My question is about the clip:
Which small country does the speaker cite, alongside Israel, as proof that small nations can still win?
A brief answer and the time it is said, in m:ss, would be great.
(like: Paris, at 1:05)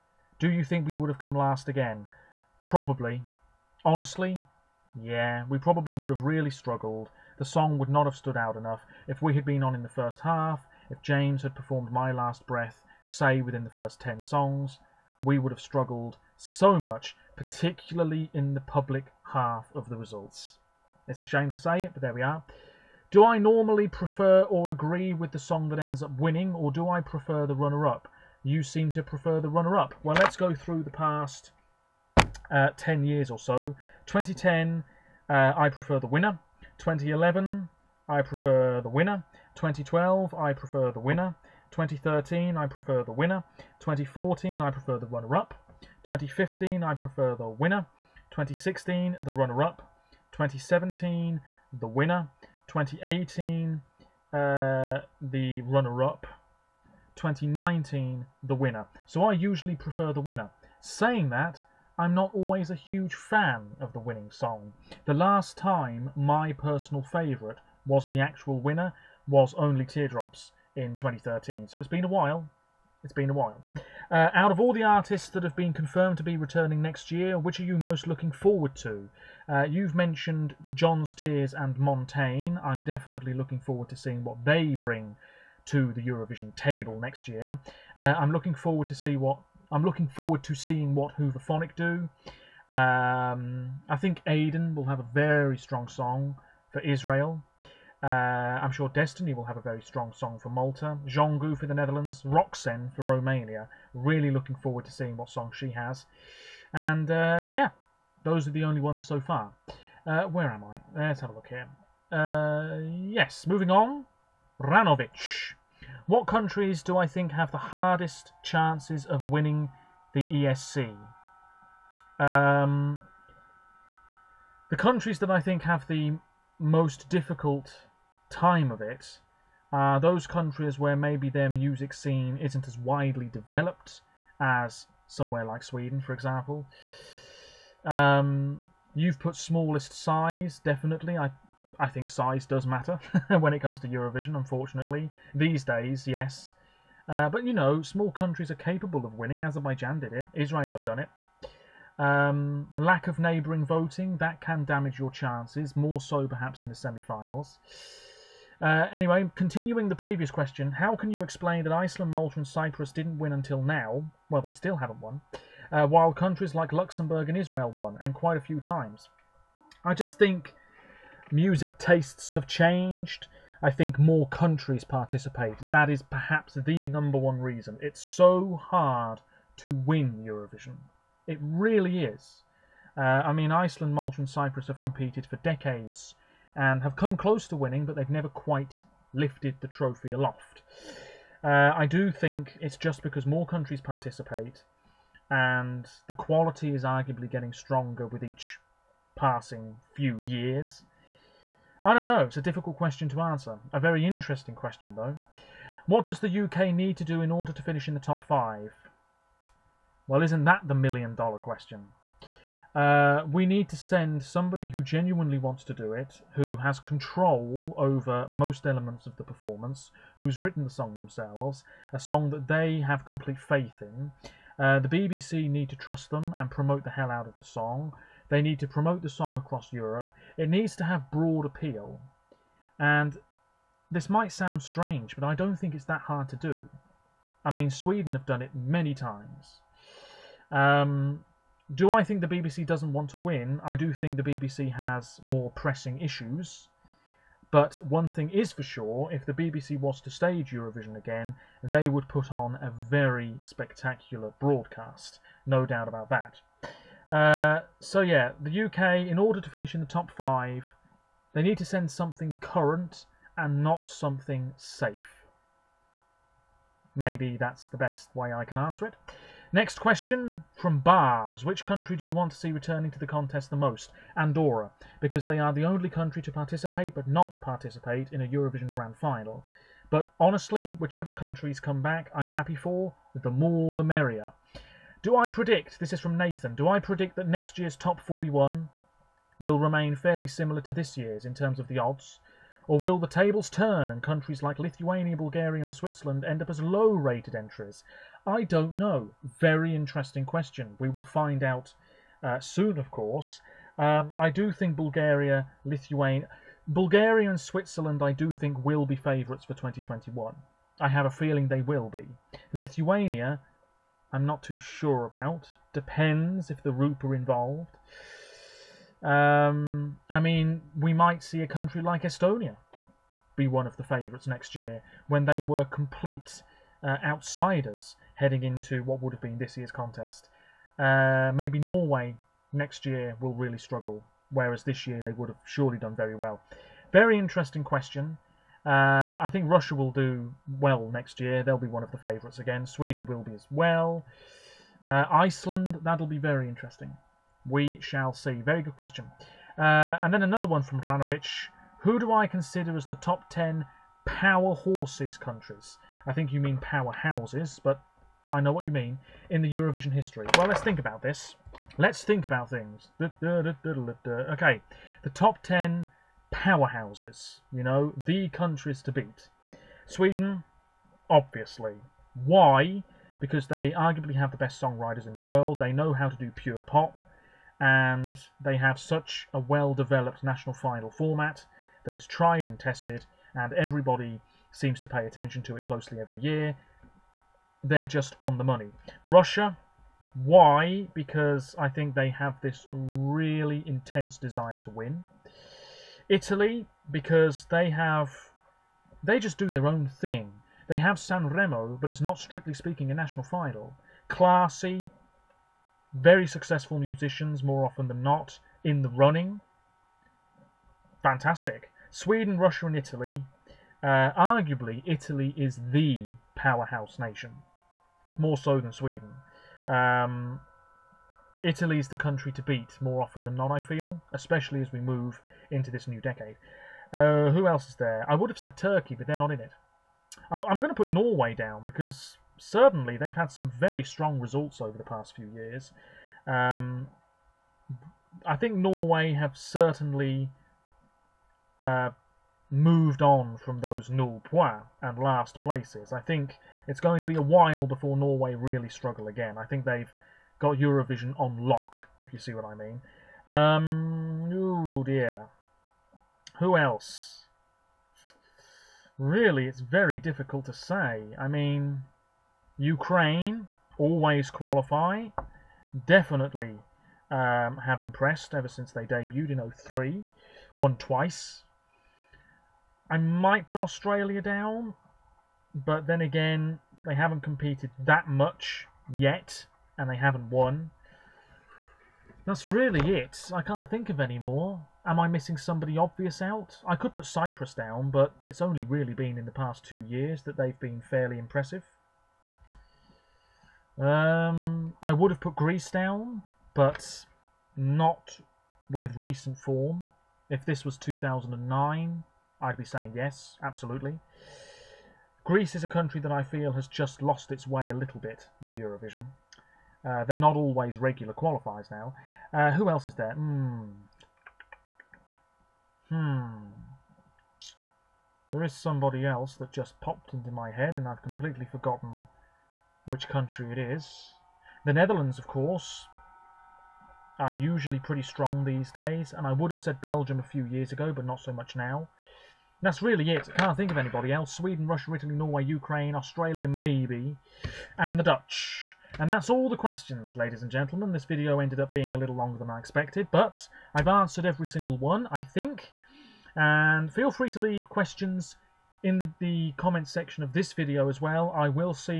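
Azerbaijan, at 2:29.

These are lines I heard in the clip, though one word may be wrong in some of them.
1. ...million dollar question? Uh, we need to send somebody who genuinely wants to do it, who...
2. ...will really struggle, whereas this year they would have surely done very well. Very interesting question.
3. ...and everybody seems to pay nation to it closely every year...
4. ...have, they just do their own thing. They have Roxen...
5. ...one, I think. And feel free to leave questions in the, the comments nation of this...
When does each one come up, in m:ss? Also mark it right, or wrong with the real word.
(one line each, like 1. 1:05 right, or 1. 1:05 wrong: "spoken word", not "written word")
1. 3:30 right
2. 5:33 right
3. 6:23 wrong: "attention", not "nation"
4. 6:37 wrong: "San", not "Roxen"
5. 9:04 wrong: "section", not "nation".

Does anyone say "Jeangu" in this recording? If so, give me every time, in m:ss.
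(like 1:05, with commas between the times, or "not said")
1:41.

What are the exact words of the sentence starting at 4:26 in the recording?
Maybe that's the best way I can answer it.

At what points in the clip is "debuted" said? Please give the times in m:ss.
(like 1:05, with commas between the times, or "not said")
7:48.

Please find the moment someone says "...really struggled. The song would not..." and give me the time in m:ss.
0:06.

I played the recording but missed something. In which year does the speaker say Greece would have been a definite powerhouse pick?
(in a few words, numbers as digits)
2009.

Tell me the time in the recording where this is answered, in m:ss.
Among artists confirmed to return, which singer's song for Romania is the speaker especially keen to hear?
1:42.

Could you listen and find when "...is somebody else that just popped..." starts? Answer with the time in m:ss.
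8:38.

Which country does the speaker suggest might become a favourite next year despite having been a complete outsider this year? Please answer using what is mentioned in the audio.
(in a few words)
Estonia.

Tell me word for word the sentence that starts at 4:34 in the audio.
Andorra, because they are the only country to participate but not participate in a Eurovision Grand Final.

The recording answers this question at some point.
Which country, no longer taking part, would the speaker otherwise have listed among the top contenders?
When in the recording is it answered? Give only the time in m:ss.
7:08.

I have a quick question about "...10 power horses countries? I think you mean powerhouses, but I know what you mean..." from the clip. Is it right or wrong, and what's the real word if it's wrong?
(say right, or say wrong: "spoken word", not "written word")
right.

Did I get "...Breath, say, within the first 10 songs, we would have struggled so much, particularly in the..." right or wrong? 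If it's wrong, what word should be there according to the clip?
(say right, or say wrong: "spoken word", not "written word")
right.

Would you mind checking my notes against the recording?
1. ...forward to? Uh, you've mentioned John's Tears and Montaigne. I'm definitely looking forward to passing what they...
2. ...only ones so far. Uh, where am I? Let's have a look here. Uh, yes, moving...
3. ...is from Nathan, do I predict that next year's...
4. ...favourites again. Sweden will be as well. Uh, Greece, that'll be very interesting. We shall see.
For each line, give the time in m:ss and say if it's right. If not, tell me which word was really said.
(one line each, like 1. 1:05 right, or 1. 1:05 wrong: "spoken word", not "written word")
1. 1:18 wrong: "seeing", not "passing"
2. 1:48 right
3. 4:45 right
4. 5:41 wrong: "Iceland", not "Greece".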